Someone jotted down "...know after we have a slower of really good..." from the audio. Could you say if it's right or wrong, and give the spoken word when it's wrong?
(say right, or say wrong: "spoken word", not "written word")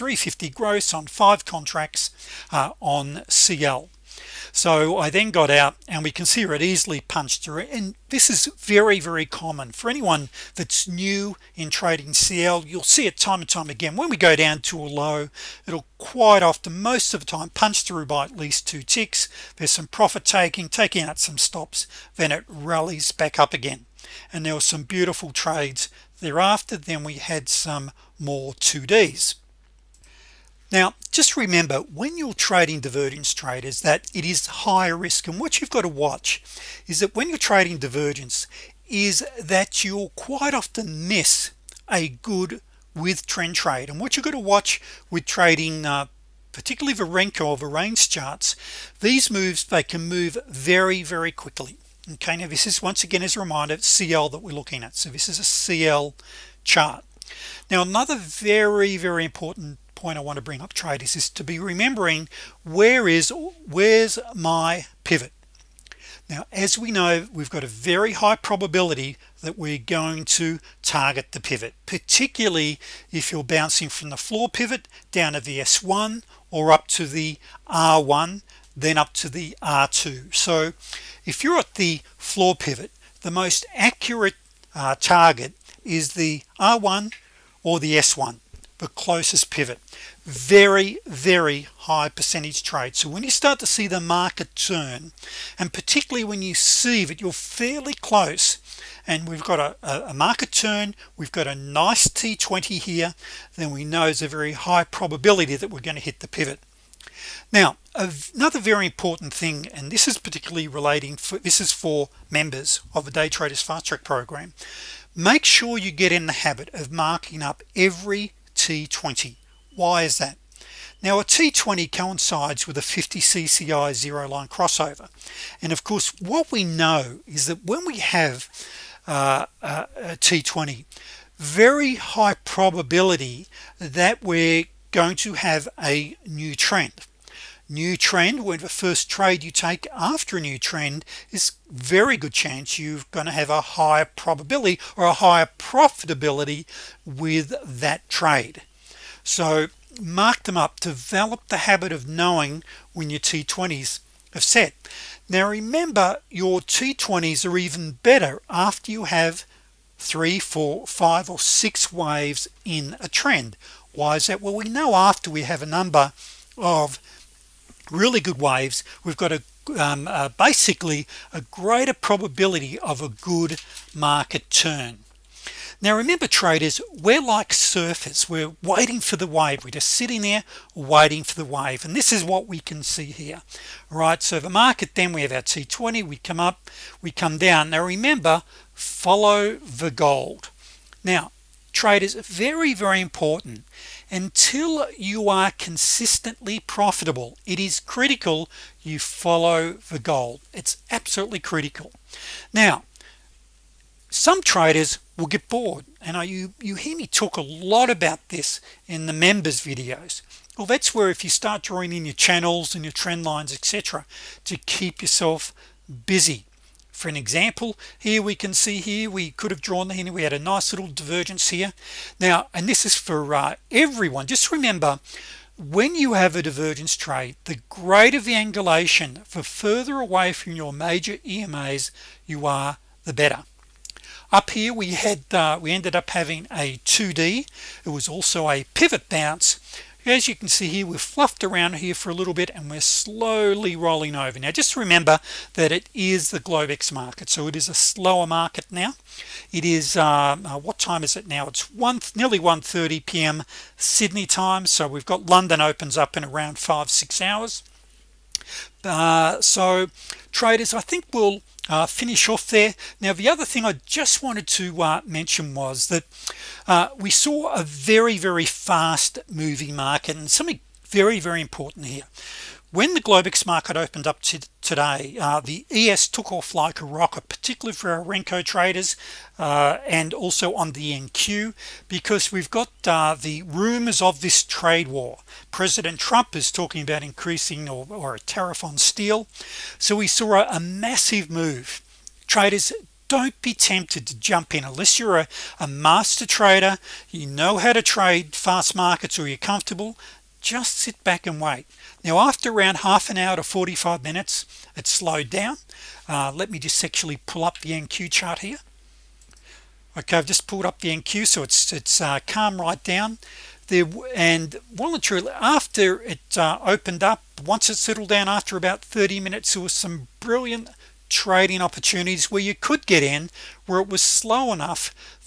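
wrong: "number", not "slower".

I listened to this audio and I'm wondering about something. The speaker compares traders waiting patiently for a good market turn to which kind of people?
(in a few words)
surfers.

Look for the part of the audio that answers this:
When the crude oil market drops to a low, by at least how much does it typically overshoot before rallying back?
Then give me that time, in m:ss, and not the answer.
0:18.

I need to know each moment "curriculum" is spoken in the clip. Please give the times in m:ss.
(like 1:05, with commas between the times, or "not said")
not said.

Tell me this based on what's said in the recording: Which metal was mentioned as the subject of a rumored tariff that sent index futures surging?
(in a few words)
steel.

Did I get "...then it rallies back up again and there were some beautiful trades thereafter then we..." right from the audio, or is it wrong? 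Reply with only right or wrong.
right.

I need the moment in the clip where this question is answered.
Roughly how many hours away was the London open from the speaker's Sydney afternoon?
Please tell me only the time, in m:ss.
4:16.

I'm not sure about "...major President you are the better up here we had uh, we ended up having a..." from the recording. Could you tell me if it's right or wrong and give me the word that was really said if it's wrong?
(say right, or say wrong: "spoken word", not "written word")
wrong: "EMAs", not "President".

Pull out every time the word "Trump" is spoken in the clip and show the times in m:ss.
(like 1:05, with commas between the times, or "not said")
4:45.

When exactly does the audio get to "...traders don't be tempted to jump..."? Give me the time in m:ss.
4:52.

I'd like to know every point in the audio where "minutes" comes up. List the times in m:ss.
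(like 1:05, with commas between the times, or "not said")
5:04, 5:19.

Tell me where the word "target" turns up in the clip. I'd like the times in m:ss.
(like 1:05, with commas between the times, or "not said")
1:10, 1:24.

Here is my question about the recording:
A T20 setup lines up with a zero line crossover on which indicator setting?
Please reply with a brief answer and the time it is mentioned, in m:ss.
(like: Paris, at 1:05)
50 CCI, at 2:02.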